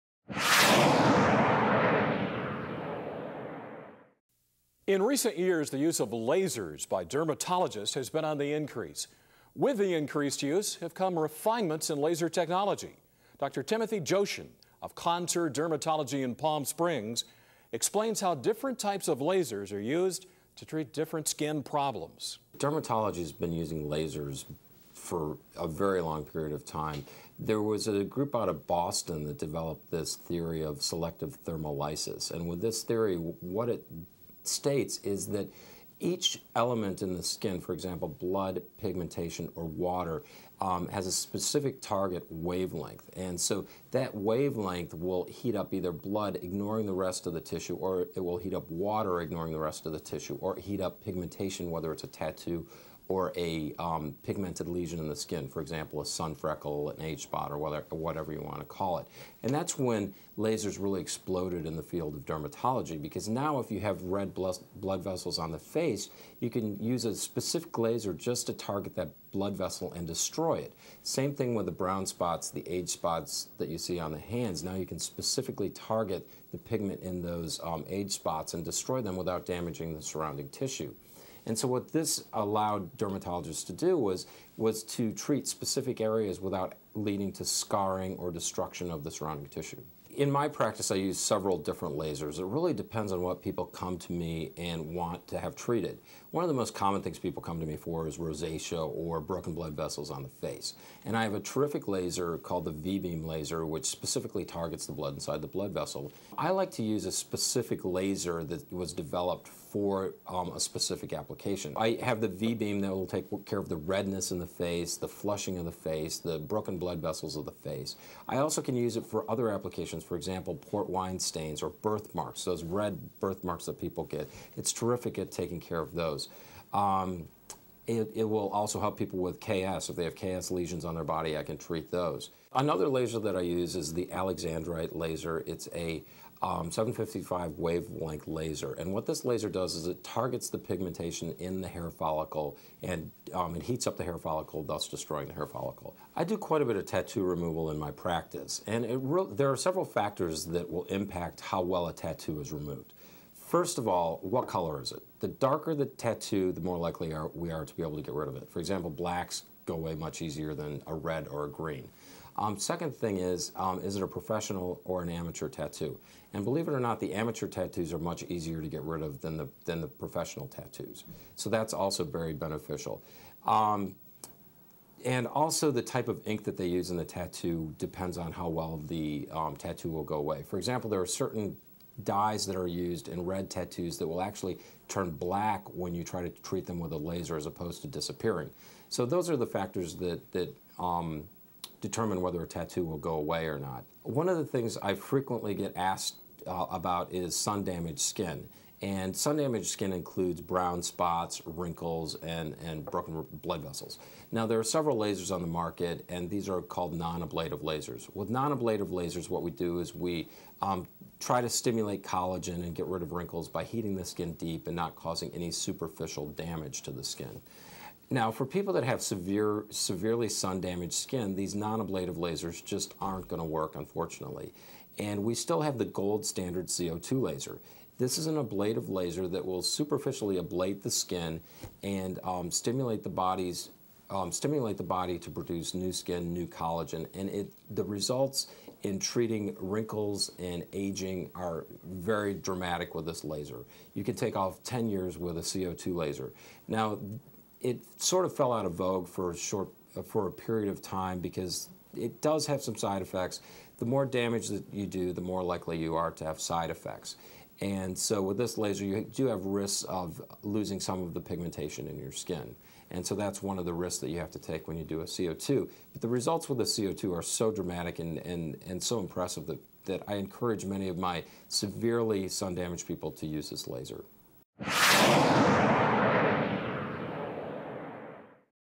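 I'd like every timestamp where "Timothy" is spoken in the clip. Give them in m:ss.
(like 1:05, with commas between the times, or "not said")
0:13.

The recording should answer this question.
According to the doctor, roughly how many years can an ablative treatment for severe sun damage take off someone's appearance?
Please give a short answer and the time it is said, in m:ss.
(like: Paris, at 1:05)
10 years, at 4:04.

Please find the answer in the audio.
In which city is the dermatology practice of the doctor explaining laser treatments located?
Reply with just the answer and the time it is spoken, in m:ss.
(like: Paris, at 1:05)
Palm Springs, at 0:16.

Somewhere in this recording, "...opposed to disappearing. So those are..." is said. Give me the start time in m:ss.
3:07.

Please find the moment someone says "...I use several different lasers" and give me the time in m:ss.
1:30.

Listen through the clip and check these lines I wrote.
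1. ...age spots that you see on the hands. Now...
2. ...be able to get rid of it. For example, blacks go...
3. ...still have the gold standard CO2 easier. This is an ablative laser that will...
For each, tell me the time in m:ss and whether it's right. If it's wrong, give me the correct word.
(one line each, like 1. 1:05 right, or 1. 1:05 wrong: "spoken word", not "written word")
1. 1:12 right
2. 2:37 right
3. 3:45 wrong: "laser", not "easier".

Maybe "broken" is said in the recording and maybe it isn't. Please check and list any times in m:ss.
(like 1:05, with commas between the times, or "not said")
1:39, 1:56, 3:22.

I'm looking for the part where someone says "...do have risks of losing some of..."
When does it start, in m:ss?
4:19.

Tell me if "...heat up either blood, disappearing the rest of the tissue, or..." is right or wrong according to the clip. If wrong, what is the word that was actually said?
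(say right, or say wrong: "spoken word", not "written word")
wrong: "ignoring", not "disappearing".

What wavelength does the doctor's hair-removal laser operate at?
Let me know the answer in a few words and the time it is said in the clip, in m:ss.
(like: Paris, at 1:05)
755, at 2:16.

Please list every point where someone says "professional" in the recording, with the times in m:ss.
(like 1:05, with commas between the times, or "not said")
2:44, 2:49.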